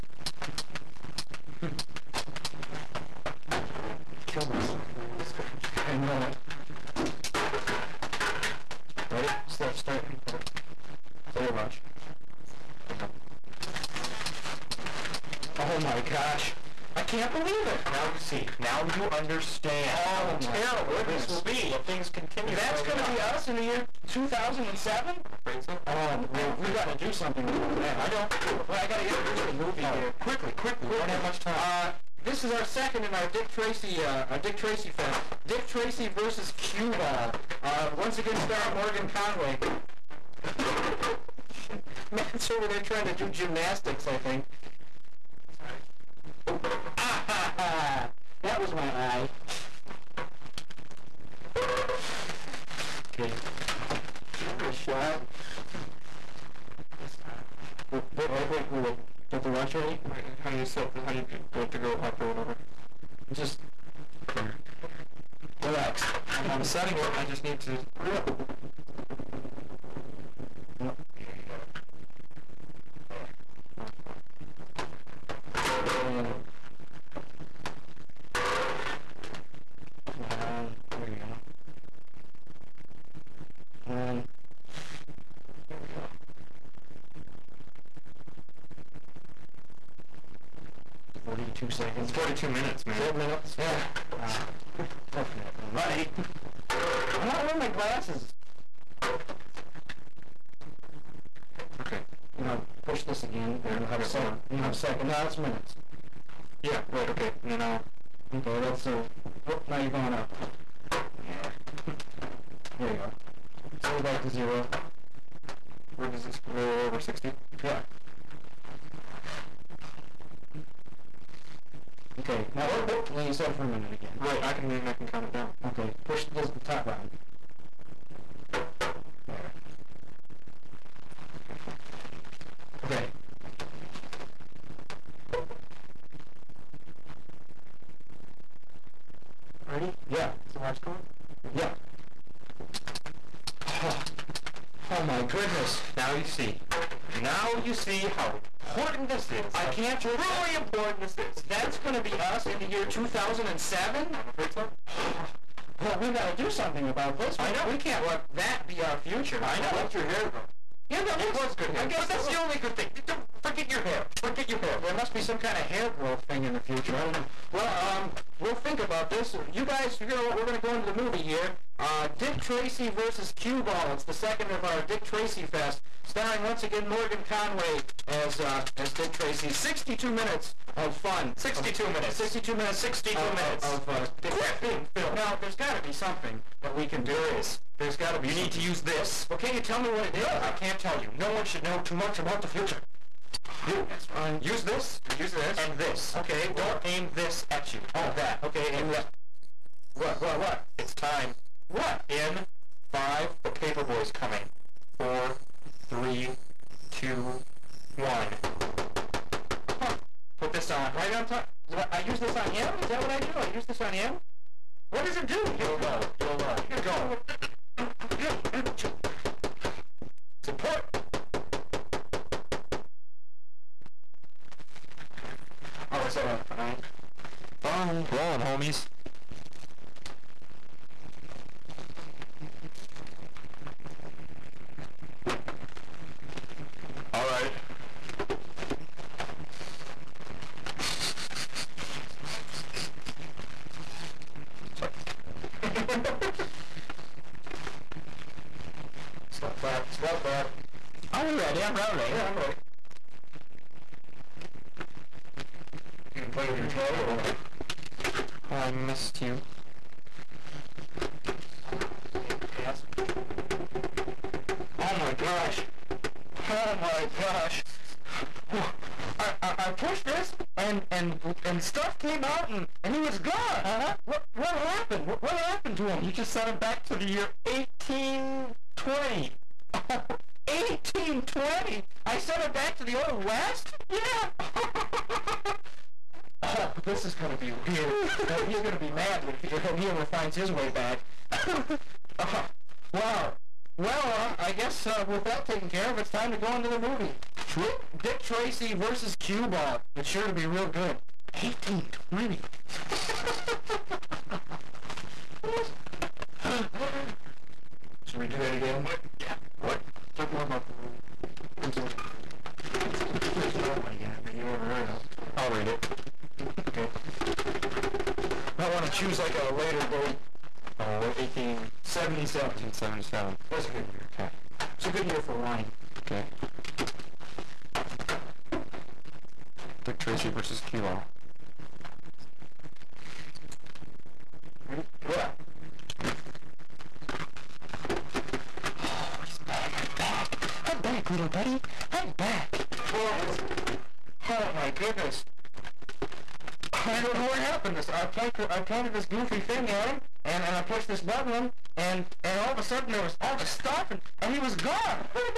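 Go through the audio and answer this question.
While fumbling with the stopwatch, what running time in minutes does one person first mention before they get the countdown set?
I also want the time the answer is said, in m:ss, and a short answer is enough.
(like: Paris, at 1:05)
42, at 1:32.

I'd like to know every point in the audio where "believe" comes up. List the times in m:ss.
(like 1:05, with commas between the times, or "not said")
0:17, 2:30.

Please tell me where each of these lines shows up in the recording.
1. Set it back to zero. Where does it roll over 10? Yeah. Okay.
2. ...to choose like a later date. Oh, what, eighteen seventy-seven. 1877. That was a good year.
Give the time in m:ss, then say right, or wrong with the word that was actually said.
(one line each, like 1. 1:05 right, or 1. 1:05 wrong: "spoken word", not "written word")
1. 1:53 wrong: "60", not "10"
2. 5:18 right.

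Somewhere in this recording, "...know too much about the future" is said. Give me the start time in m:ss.
3:11.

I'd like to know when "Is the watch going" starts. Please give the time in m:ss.
2:20.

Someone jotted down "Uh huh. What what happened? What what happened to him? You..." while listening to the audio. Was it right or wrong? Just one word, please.
right.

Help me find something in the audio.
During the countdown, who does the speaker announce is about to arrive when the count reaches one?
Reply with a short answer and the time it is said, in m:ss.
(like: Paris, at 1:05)
the paper boy, at 3:23.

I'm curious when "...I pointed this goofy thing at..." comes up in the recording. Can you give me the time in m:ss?
5:48.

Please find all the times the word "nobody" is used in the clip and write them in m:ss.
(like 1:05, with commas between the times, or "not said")
5:13.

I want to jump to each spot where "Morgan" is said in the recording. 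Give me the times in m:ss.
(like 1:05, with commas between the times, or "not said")
0:38, 2:56.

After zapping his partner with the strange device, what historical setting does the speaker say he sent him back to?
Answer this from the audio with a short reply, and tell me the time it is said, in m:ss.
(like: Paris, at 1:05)
the old west, at 4:42.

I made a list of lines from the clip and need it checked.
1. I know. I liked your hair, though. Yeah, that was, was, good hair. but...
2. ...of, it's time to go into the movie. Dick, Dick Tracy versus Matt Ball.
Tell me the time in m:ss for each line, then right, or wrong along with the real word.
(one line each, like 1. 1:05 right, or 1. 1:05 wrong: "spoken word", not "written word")
1. 2:39 right
2. 4:55 wrong: "Cue", not "Matt".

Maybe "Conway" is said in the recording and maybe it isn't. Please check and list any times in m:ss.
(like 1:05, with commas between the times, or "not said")
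0:39, 2:57.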